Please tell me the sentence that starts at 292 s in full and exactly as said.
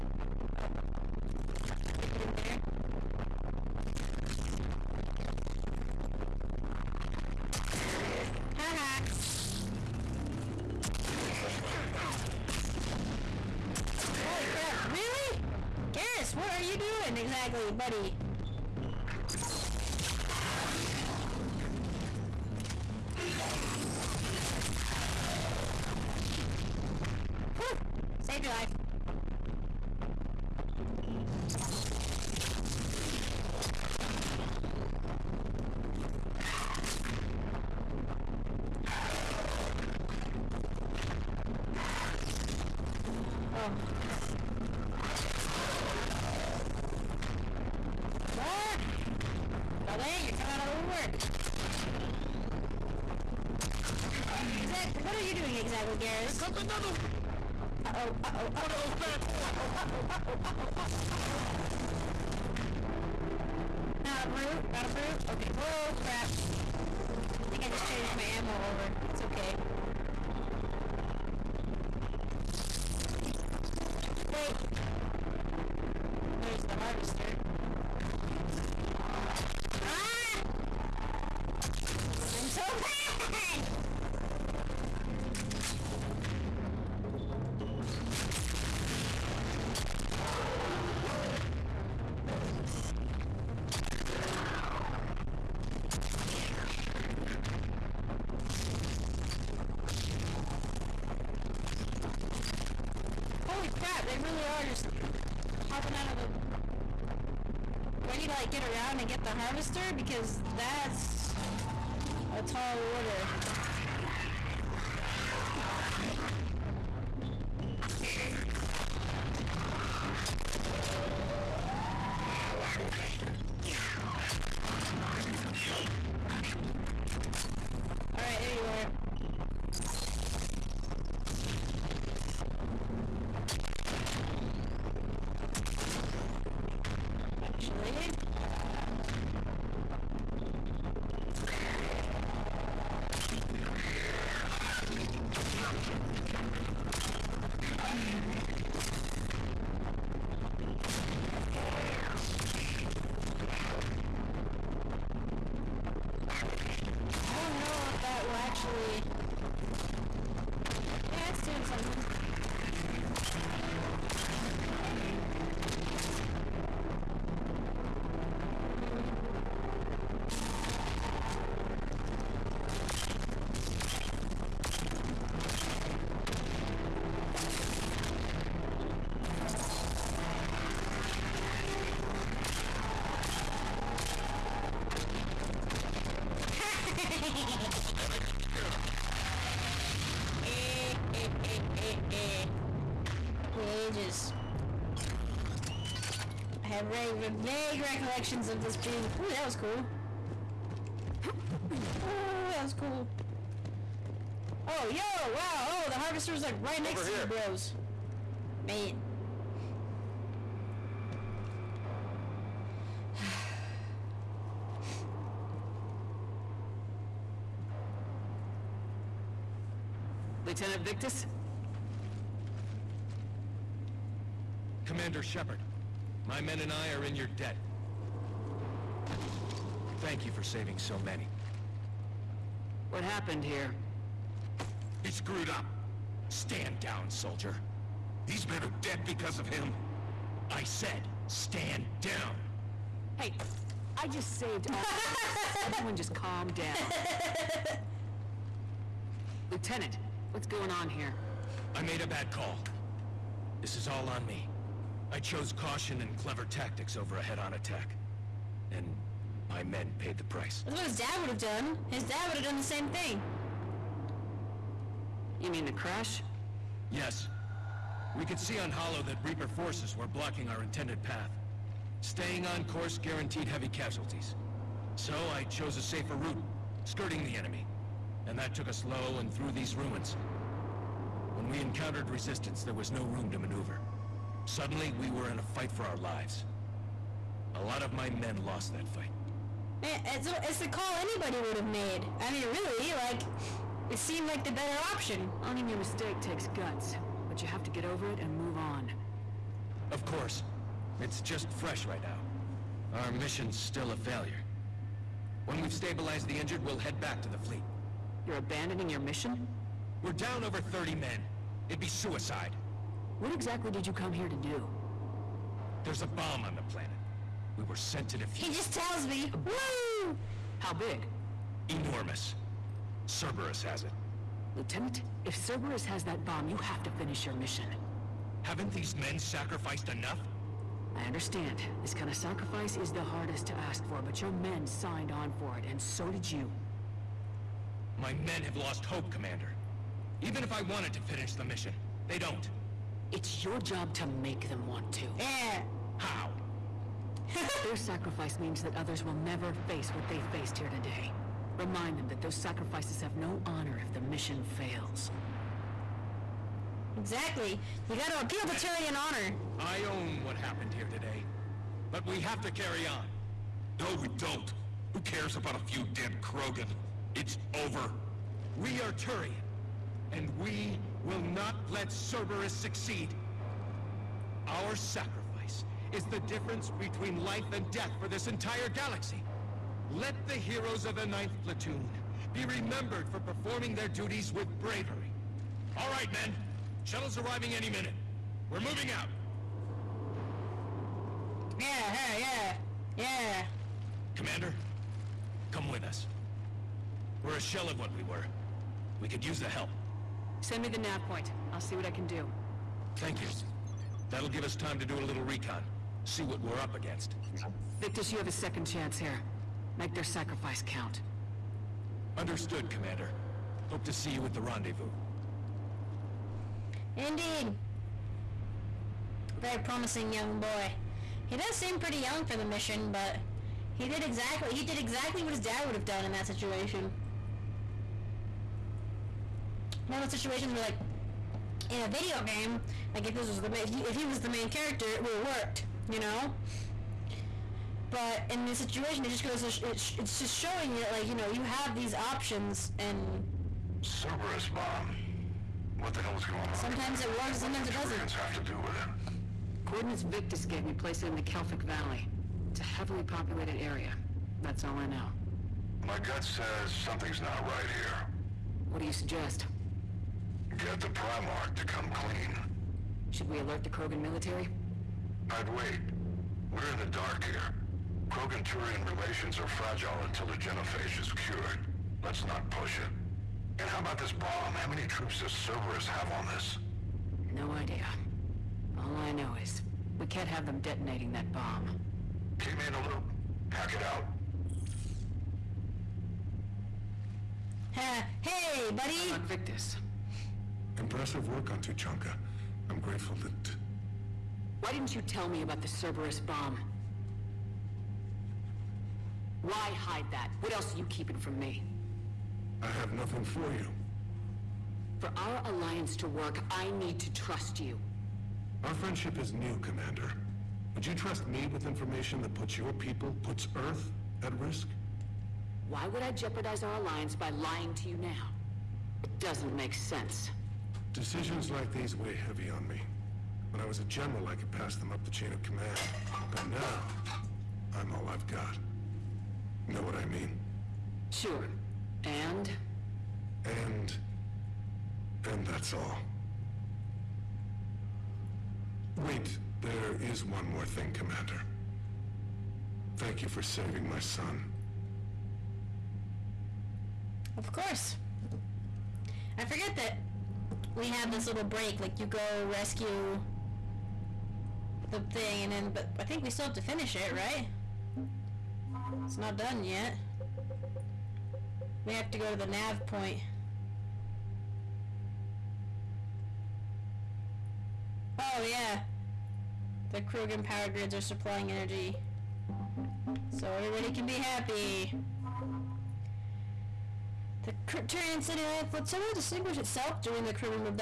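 I mean, really, like, it seemed like the better option.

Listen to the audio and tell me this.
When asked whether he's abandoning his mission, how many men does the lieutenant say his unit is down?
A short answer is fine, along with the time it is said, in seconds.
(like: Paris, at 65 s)
over 30, at 310 s.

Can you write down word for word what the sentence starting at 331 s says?
This kind of sacrifice is the hardest to ask for, but your men signed on for it, and so did you.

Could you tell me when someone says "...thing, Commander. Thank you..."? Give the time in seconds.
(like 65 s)
540 s.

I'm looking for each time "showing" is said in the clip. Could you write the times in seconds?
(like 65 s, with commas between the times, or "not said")
440 s.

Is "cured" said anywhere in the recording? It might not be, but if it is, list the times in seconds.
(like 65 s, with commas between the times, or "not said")
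471 s.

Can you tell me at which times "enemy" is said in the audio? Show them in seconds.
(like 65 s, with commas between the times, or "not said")
277 s.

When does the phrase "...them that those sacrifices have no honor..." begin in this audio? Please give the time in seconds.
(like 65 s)
351 s.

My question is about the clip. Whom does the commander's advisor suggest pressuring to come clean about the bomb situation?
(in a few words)
the Primarch.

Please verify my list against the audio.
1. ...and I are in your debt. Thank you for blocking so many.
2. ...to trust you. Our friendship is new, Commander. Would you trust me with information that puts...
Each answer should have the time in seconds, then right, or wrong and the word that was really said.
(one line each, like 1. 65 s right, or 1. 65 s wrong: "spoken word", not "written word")
1. 226 s wrong: "saving", not "blocking"
2. 507 s right.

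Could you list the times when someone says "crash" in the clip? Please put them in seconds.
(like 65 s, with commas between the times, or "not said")
265 s.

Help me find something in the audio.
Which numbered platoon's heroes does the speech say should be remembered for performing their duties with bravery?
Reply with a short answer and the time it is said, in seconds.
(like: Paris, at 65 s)
9th Platoon, at 381 s.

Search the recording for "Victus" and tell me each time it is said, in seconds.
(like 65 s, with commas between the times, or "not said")
220 s, 407 s, 450 s.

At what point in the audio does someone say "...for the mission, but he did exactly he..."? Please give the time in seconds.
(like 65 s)
422 s.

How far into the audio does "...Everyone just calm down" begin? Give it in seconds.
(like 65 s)
245 s.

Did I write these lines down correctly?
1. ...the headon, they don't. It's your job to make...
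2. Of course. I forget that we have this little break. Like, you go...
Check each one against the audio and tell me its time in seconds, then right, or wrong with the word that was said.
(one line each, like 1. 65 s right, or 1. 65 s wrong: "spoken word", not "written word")
1. 341 s wrong: "mission", not "headon"
2. 547 s right.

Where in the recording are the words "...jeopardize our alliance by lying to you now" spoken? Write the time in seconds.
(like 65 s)
516 s.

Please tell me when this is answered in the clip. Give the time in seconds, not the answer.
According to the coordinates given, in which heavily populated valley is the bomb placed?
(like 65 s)
451 s.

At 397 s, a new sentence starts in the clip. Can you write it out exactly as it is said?
We're a shell of what we were.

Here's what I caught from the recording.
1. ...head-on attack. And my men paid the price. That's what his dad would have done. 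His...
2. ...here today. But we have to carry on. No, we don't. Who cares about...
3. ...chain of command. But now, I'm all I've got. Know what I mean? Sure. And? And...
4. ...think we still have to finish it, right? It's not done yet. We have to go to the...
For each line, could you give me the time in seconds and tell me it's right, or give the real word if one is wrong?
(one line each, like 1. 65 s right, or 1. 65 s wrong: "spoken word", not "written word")
1. 257 s right
2. 360 s right
3. 525 s right
4. 556 s right.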